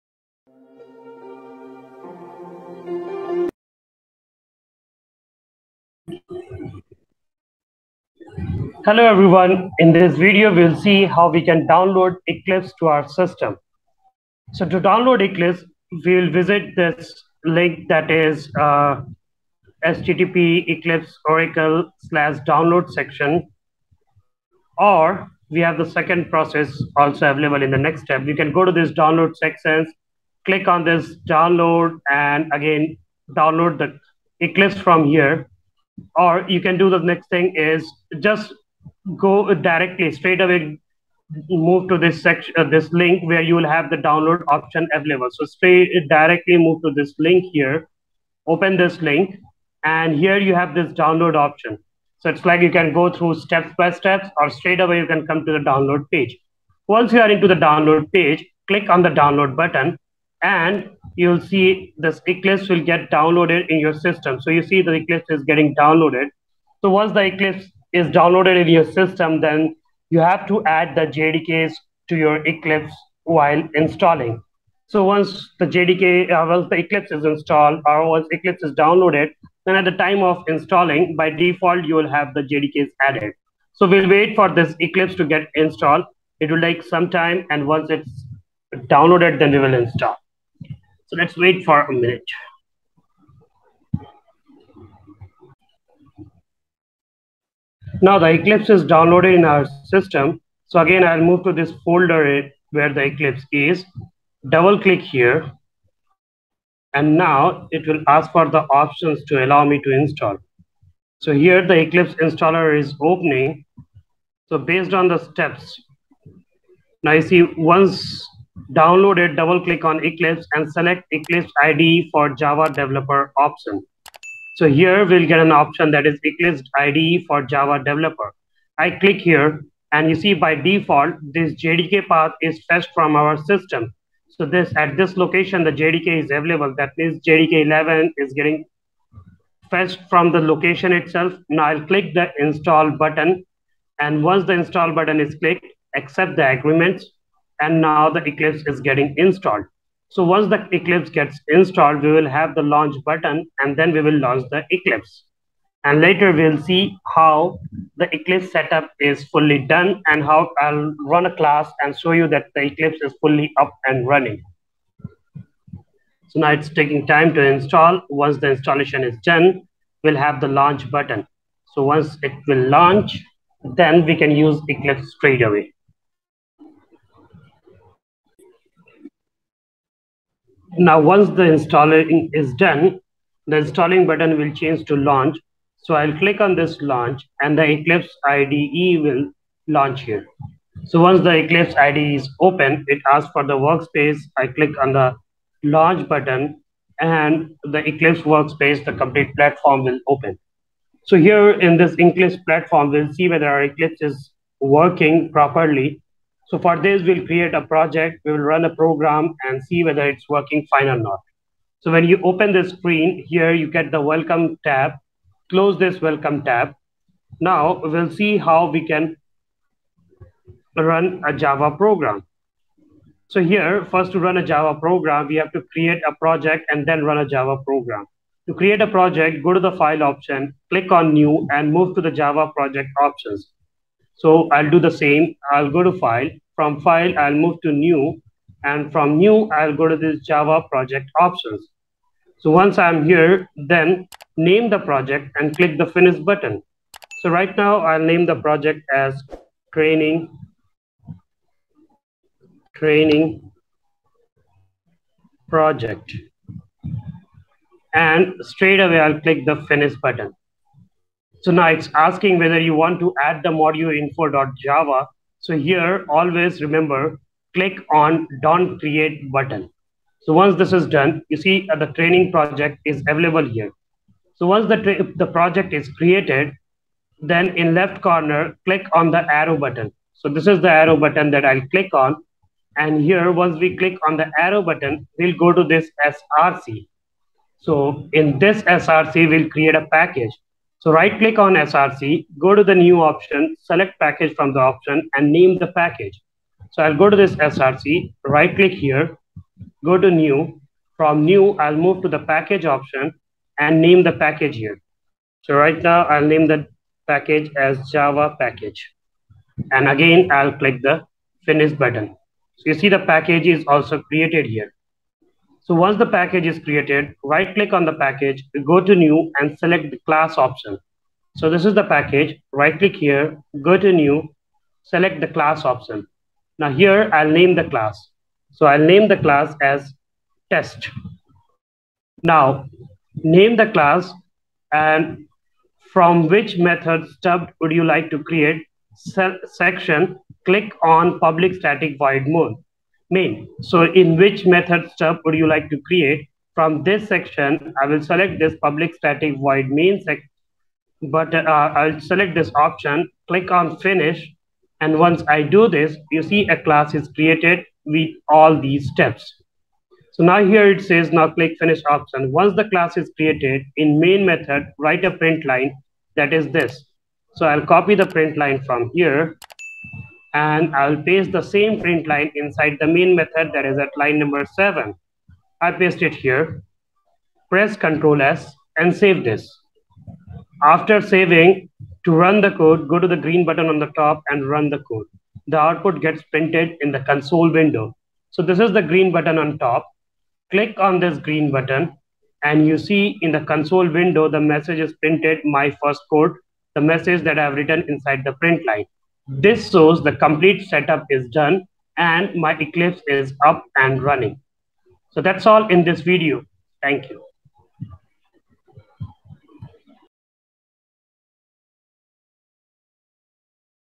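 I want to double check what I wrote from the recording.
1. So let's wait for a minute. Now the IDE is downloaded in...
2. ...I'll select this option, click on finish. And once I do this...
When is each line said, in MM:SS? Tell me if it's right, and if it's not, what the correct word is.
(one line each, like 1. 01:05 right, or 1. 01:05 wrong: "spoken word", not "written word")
1. 01:30 wrong: "Eclipse", not "IDE"
2. 05:51 right.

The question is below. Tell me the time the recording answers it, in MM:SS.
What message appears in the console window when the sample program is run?
06:35.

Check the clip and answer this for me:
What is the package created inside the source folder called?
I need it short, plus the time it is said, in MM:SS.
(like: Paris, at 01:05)
Java package, at 05:07.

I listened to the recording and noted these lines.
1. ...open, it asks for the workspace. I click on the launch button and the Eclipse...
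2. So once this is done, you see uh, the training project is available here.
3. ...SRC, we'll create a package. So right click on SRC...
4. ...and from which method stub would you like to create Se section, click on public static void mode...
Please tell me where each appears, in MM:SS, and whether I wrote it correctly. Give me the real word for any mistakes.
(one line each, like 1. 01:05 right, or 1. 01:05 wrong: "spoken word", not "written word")
1. 03:12 right
2. 04:30 right
3. 04:48 right
4. 05:34 right.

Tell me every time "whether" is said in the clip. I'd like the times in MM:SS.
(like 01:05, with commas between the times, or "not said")
03:23, 03:29, 04:22.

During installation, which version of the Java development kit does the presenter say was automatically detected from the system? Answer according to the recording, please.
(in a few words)
JDK 11.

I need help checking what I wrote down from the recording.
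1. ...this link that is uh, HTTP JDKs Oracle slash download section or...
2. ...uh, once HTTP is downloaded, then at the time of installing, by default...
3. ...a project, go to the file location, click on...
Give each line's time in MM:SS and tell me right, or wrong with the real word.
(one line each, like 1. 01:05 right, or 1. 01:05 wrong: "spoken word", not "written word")
1. 00:16 wrong: "Eclipse", not "JDKs"
2. 01:18 wrong: "Eclipse", not "HTTP"
3. 03:48 wrong: "option", not "location".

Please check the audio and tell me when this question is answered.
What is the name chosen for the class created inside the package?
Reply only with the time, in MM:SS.
05:30.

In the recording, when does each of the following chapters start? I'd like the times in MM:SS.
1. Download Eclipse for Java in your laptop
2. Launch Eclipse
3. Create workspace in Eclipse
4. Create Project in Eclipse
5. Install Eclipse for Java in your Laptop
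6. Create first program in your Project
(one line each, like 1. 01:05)
1. 00:14
2. 03:00
3. 03:11
4. 03:22
5. 01:30
6. 04:34.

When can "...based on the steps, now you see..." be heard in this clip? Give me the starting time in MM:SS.
01:54.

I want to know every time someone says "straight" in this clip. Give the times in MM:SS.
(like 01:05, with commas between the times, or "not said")
00:40, 00:45, 00:54, 02:55, 04:18.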